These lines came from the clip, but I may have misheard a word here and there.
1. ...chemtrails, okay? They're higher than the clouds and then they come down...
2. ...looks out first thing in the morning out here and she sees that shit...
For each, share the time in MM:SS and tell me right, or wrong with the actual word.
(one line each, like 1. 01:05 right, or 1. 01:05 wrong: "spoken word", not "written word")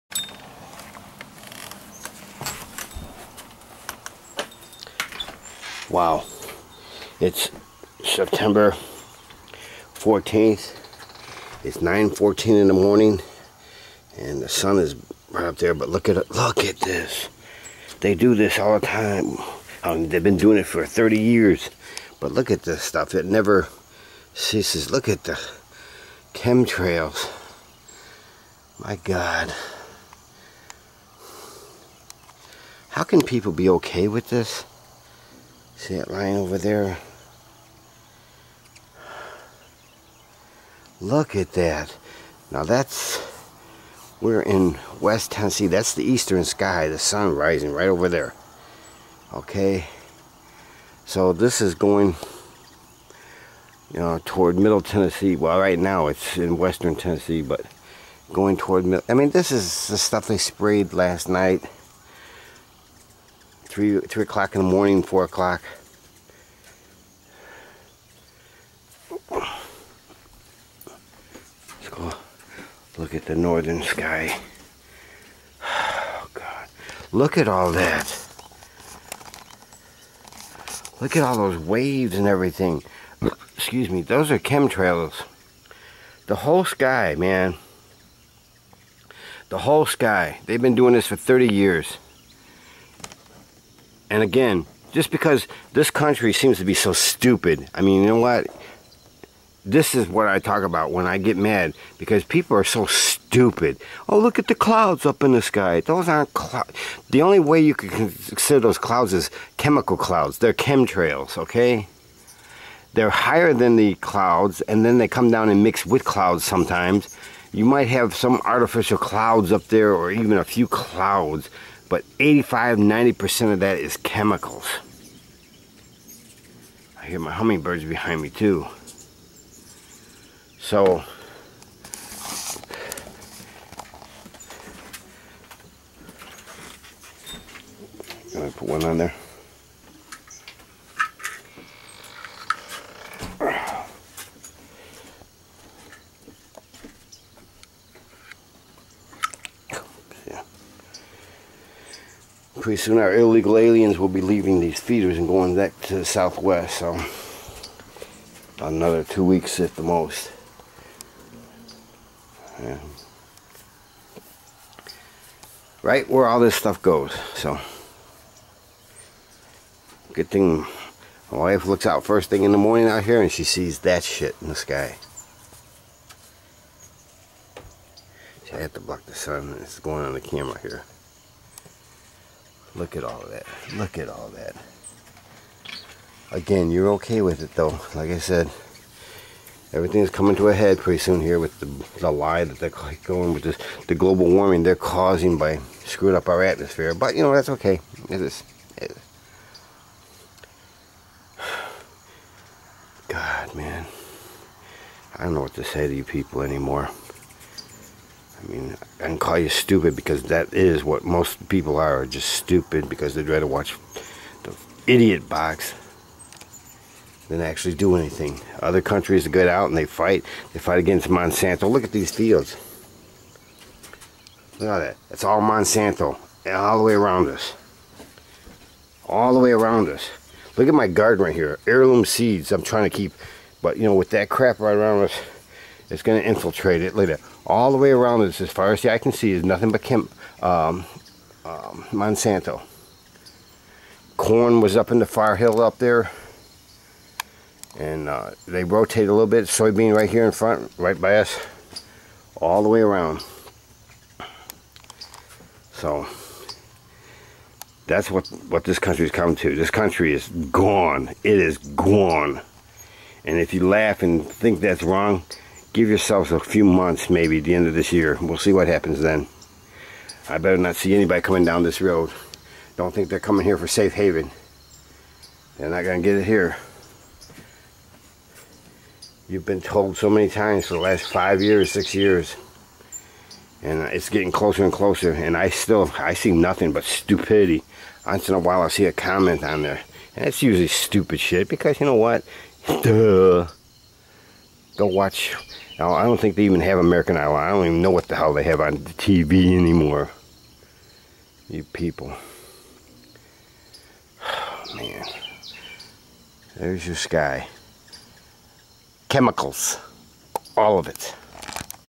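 1. 01:50 right
2. 02:51 right.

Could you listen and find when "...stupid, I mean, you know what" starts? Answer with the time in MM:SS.
01:36.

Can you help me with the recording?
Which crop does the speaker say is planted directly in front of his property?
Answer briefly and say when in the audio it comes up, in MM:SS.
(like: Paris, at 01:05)
Soybean, at 04:09.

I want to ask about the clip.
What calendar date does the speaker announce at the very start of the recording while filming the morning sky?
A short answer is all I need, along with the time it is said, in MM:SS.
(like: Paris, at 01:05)
September 14th, at 00:08.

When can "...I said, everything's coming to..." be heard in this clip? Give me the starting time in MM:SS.
03:08.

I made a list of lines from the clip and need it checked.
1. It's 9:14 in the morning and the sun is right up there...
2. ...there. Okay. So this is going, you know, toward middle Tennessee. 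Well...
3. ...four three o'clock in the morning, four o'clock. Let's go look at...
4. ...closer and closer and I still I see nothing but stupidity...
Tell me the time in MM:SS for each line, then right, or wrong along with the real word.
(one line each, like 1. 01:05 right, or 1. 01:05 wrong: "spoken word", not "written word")
1. 00:11 right
2. 00:48 right
3. 01:03 wrong: "three", not "four"
4. 04:44 right.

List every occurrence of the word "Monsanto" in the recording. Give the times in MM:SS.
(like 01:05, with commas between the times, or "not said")
03:41, 03:45, 04:01.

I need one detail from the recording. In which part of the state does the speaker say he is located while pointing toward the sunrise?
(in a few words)
West Tennessee.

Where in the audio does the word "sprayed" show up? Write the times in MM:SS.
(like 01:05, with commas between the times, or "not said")
01:00.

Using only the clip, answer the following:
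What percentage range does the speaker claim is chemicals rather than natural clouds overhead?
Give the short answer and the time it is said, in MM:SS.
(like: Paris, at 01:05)
85-90%, at 02:02.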